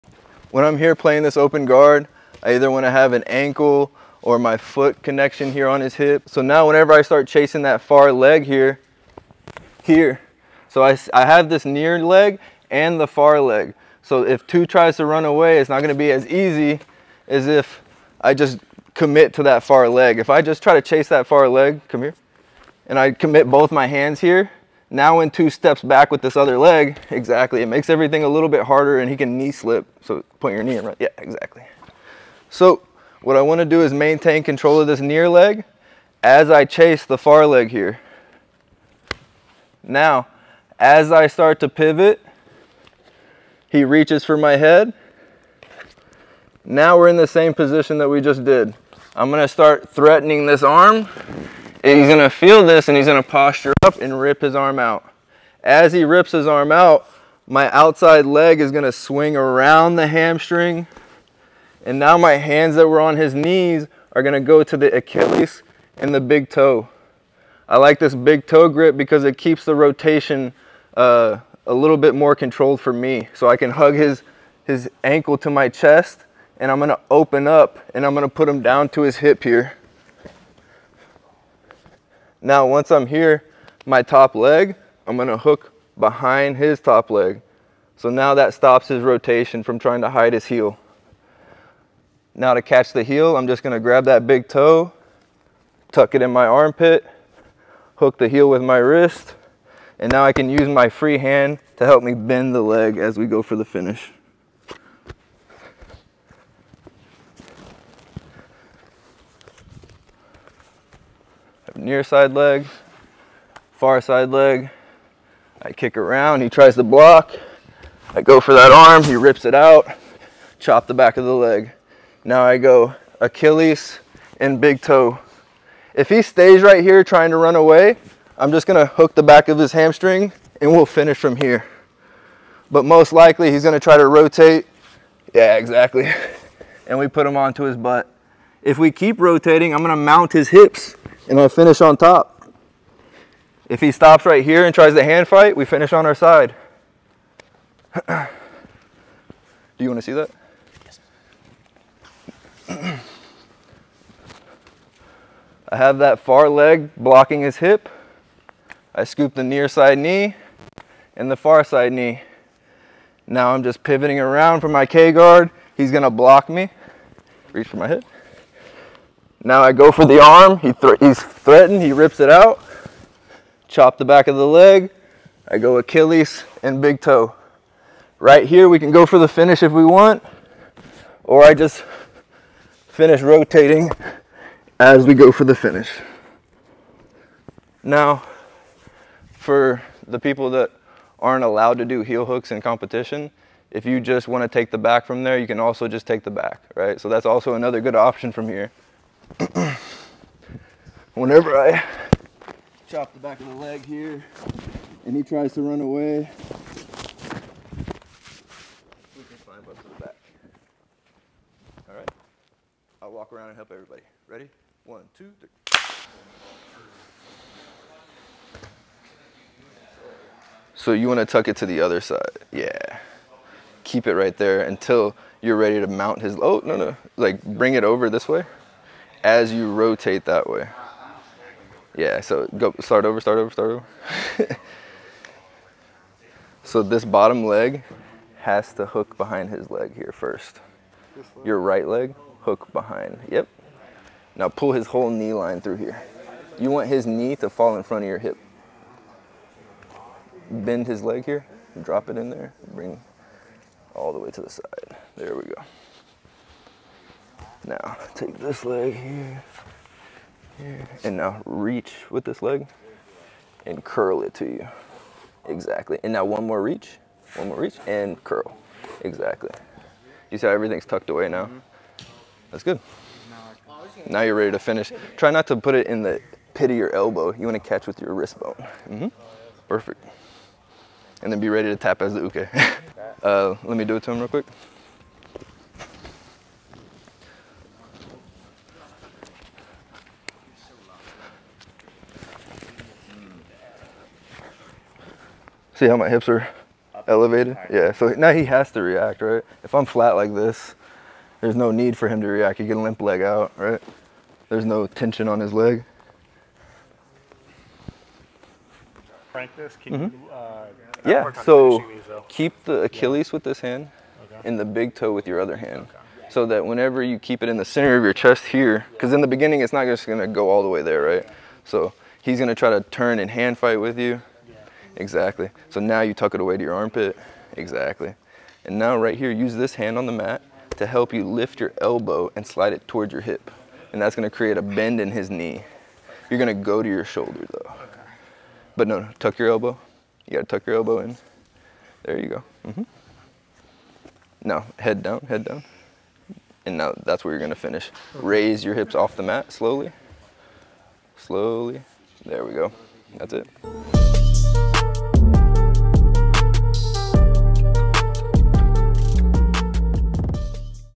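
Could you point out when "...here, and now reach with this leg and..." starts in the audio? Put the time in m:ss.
4:20.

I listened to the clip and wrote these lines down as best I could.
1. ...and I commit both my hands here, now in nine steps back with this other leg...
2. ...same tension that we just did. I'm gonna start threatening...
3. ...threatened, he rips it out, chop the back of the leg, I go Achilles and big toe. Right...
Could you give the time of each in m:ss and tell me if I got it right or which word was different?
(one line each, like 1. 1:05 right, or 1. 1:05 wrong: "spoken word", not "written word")
1. 0:22 wrong: "two", not "nine"
2. 0:47 wrong: "position", not "tension"
3. 2:51 right.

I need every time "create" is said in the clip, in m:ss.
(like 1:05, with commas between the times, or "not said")
5:34.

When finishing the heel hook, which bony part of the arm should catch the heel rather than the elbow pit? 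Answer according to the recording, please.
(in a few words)
wrist bone.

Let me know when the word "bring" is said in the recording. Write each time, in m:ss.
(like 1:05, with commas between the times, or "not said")
3:47, 4:12.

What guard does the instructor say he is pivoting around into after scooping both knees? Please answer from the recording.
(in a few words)
K guard.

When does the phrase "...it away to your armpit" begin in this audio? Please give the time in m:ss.
5:26.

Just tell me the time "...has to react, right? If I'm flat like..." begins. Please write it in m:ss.
4:58.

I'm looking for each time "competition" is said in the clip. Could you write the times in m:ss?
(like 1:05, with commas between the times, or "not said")
3:12.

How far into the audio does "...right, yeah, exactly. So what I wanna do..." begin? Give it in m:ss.
0:30.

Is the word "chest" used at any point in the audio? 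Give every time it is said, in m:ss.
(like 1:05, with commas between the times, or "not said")
1:15, 5:18.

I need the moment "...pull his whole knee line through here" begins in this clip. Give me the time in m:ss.
4:04.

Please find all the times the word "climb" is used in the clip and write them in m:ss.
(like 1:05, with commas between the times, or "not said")
3:29.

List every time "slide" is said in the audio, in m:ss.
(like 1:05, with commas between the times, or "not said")
5:32.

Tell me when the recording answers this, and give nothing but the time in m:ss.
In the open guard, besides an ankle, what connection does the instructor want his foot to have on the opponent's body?
0:05.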